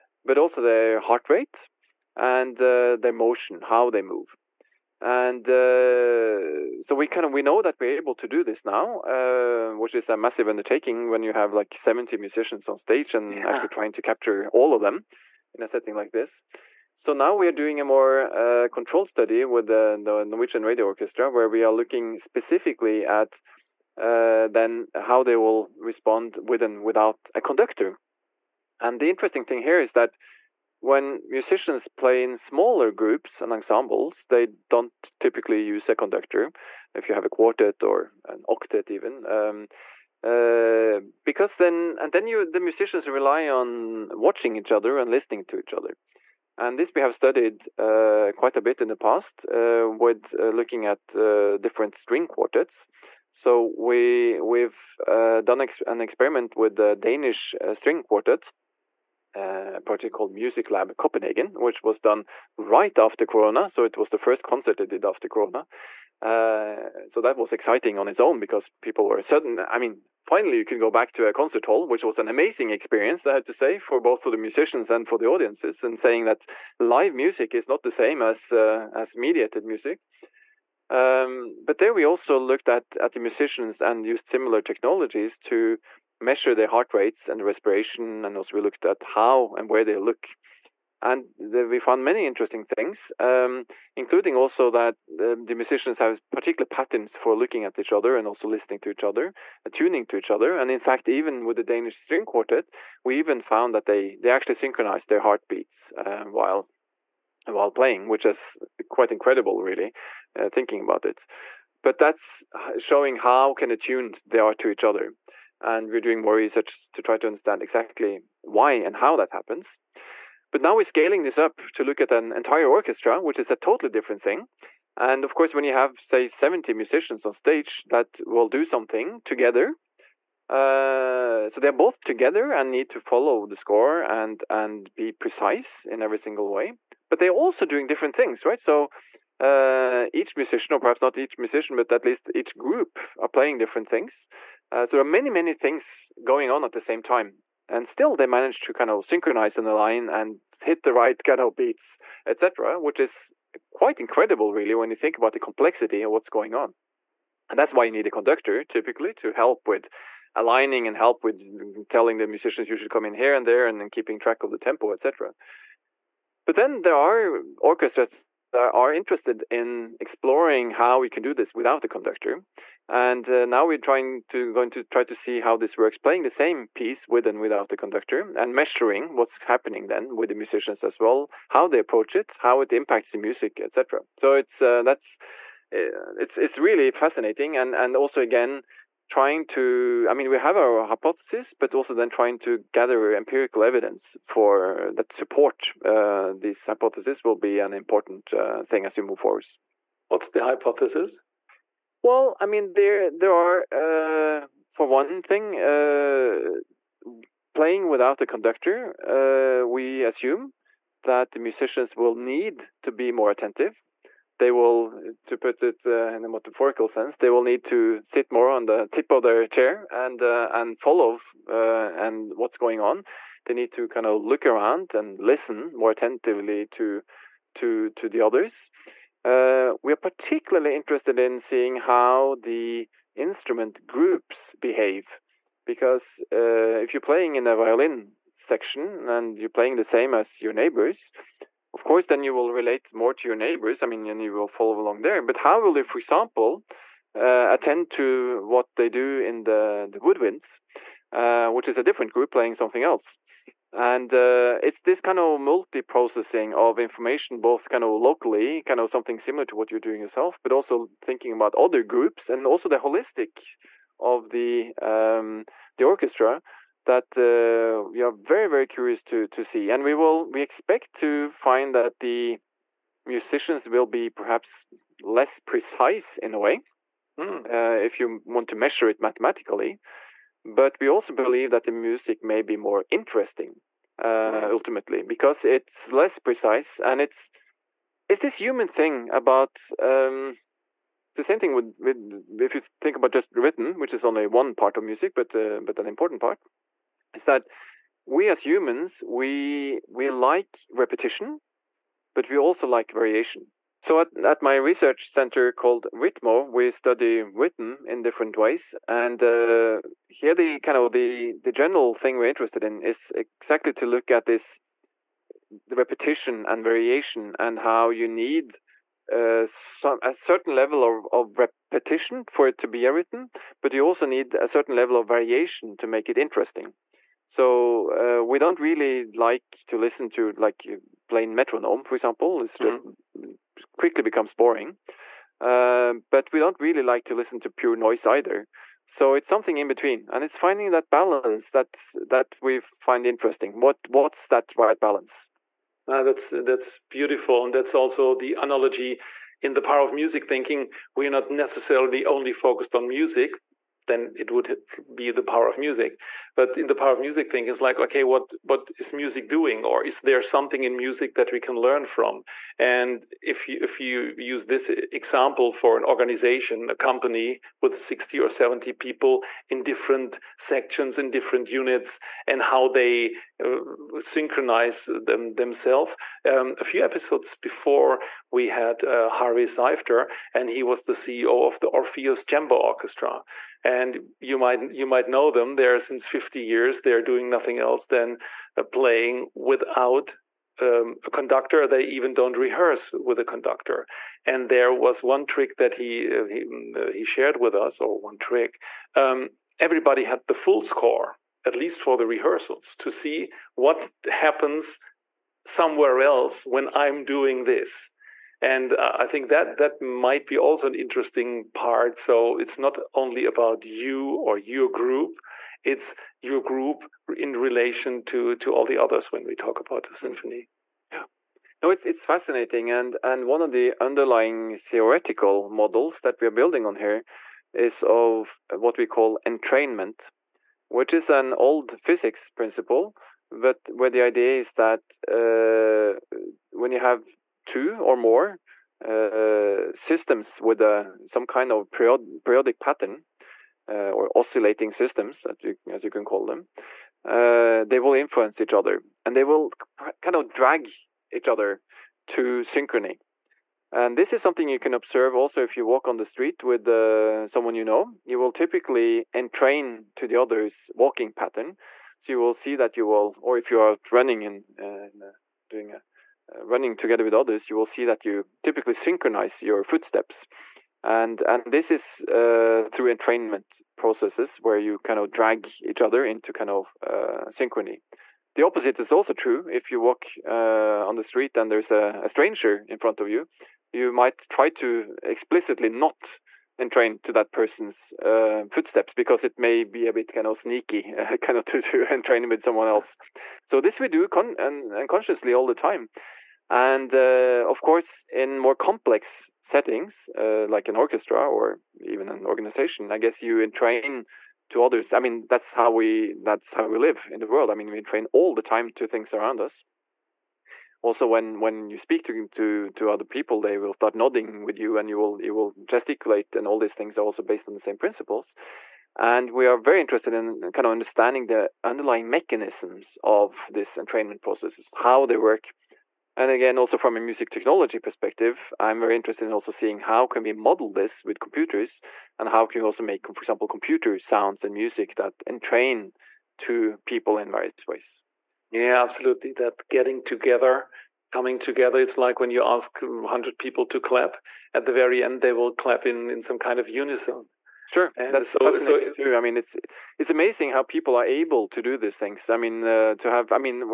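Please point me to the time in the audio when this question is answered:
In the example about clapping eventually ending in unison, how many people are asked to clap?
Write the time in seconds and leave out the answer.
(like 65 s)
542 s.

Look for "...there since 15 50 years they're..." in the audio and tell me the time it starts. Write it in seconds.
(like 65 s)
385 s.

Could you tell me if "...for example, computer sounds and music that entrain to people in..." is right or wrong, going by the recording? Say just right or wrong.
right.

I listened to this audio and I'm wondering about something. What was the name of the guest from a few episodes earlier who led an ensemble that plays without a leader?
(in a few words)
Harvey Seifter.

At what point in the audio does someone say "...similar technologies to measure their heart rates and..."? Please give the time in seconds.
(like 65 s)
84 s.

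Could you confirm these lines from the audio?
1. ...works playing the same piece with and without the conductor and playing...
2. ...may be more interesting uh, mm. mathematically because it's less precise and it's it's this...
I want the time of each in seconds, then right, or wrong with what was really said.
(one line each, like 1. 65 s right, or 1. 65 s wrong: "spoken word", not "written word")
1. 175 s wrong: "measuring", not "playing"
2. 282 s wrong: "ultimately", not "mathematically".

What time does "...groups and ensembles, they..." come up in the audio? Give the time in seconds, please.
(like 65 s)
32 s.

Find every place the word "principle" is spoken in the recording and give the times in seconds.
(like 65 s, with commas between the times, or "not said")
432 s, 517 s.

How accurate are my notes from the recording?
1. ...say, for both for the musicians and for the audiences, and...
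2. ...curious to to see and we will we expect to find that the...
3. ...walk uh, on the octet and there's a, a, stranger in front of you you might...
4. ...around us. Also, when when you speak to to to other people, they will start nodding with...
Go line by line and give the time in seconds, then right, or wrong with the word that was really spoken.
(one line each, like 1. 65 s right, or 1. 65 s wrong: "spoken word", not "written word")
1. 73 s right
2. 268 s right
3. 479 s wrong: "street", not "octet"
4. 509 s right.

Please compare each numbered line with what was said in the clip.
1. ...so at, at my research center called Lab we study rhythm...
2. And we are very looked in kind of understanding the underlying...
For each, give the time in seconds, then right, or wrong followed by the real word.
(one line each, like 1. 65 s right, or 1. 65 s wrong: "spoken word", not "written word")
1. 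303 s wrong: "RITMO", not "Lab"
2. 518 s wrong: "interested", not "looked".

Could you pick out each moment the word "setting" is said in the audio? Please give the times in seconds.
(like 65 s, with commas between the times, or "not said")
15 s, 499 s.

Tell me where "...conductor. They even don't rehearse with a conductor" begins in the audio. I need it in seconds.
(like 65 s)
391 s.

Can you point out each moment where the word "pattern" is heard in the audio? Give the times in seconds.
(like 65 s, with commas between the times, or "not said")
96 s, 442 s, 461 s.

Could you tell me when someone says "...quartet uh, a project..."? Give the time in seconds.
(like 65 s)
58 s.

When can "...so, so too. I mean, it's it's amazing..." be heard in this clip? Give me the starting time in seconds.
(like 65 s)
548 s.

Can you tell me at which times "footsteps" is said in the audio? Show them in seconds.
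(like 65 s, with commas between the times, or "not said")
469 s, 488 s.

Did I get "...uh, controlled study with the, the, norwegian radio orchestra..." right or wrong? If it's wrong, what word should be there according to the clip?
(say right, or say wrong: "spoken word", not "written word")
right.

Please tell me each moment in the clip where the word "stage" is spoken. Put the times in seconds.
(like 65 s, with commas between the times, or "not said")
12 s, 127 s.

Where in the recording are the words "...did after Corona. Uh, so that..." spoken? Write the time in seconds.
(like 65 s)
64 s.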